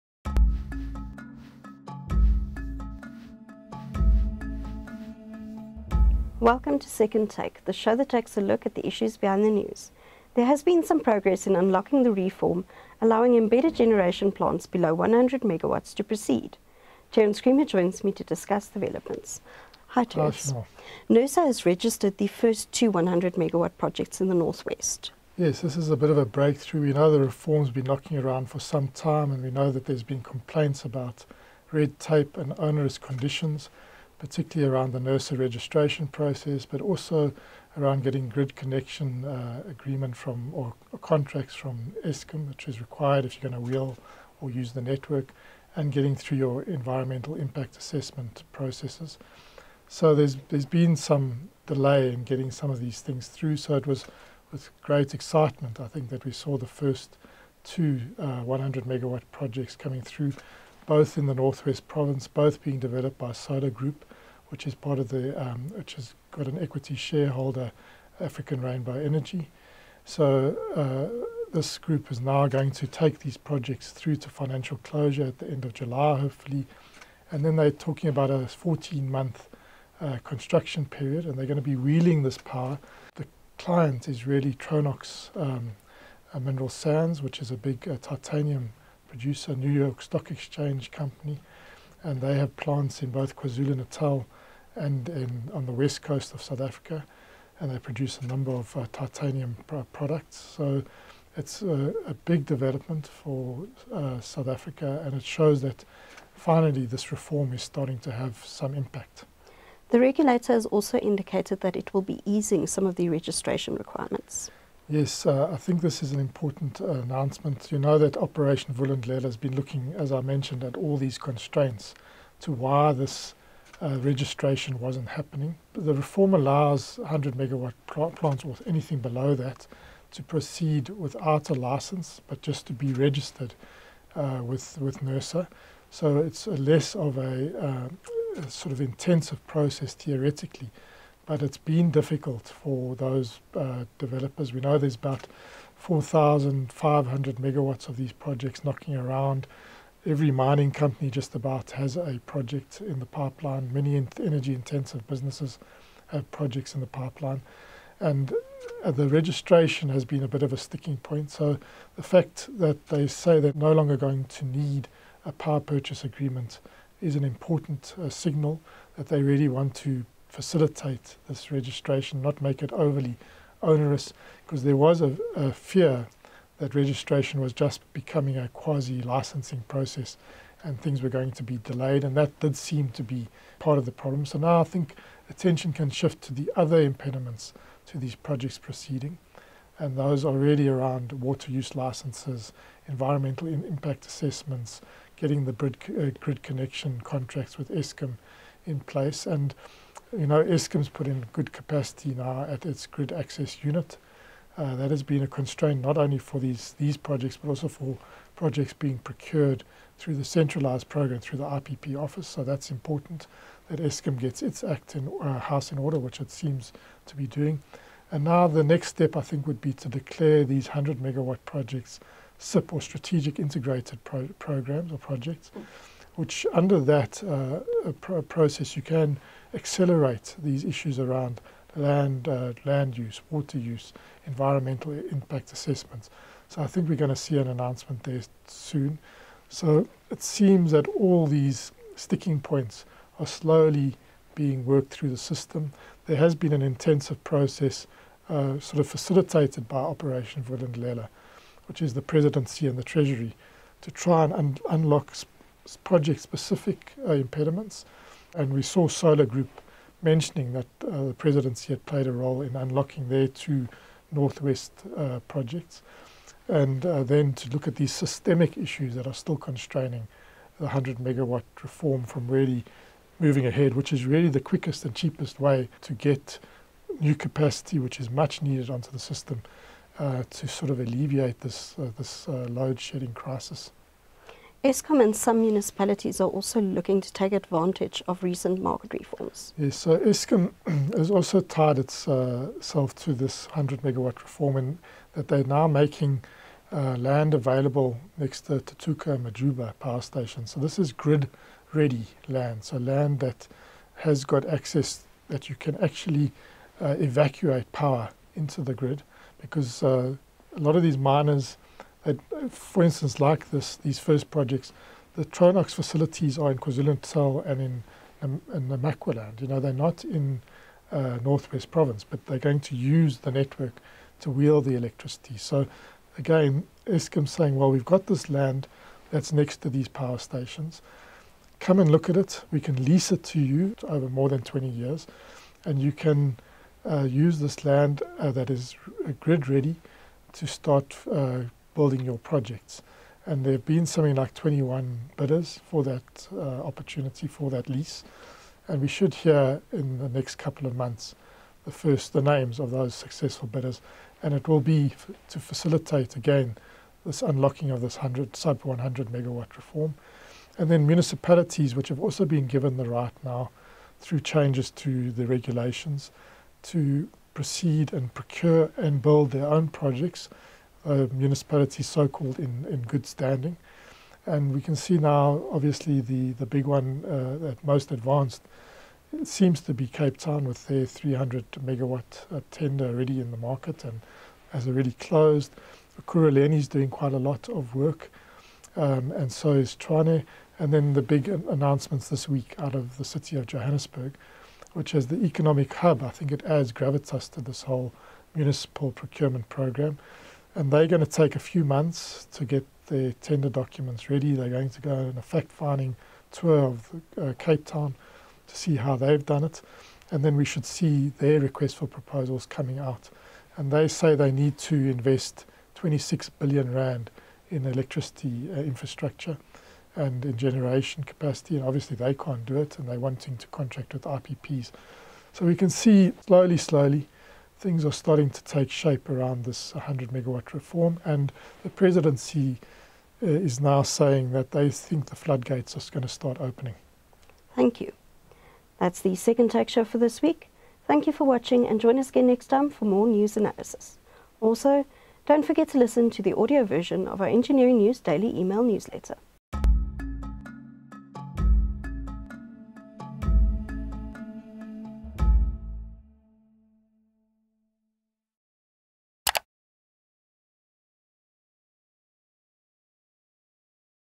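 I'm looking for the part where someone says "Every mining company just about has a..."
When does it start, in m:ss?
2:30.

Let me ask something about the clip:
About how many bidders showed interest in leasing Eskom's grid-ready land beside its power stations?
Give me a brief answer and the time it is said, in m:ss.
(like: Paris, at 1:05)
21, at 5:44.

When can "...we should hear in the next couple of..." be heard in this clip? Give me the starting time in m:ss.
5:48.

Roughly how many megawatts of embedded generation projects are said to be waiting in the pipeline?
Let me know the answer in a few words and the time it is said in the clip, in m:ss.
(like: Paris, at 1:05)
4,500 megawatts, at 2:25.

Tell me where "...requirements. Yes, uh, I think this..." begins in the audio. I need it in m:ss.
1:53.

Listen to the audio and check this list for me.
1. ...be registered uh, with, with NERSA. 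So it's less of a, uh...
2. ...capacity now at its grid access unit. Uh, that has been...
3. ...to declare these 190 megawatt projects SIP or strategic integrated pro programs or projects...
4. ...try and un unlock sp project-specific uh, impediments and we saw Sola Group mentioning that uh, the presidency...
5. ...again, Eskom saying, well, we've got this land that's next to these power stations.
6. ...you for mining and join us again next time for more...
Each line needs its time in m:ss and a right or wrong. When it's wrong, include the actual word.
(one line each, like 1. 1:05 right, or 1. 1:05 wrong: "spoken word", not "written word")
1. 2:12 right
2. 3:21 right
3. 3:39 wrong: "100", not "190"
4. 4:13 right
5. 5:26 right
6. 7:21 wrong: "watching", not "mining".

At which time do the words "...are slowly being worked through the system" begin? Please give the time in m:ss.
4:03.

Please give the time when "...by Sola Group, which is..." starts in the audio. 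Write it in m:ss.
1:03.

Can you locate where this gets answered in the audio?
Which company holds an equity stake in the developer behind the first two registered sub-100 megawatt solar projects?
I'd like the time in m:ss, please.
1:08.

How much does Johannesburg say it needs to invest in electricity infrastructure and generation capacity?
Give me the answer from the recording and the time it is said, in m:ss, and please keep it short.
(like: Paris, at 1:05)
26 billion rand, at 6:55.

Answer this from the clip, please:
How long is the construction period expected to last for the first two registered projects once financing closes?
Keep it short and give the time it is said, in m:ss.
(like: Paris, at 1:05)
14 months, at 1:18.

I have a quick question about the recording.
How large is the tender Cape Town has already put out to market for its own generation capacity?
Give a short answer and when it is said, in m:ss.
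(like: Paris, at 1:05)
300 megawatts, at 6:20.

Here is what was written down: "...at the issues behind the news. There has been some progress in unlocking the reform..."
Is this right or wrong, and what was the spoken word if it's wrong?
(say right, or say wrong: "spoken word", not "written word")
right.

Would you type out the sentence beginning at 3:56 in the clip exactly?
So I think we're going to see an announcement there soon.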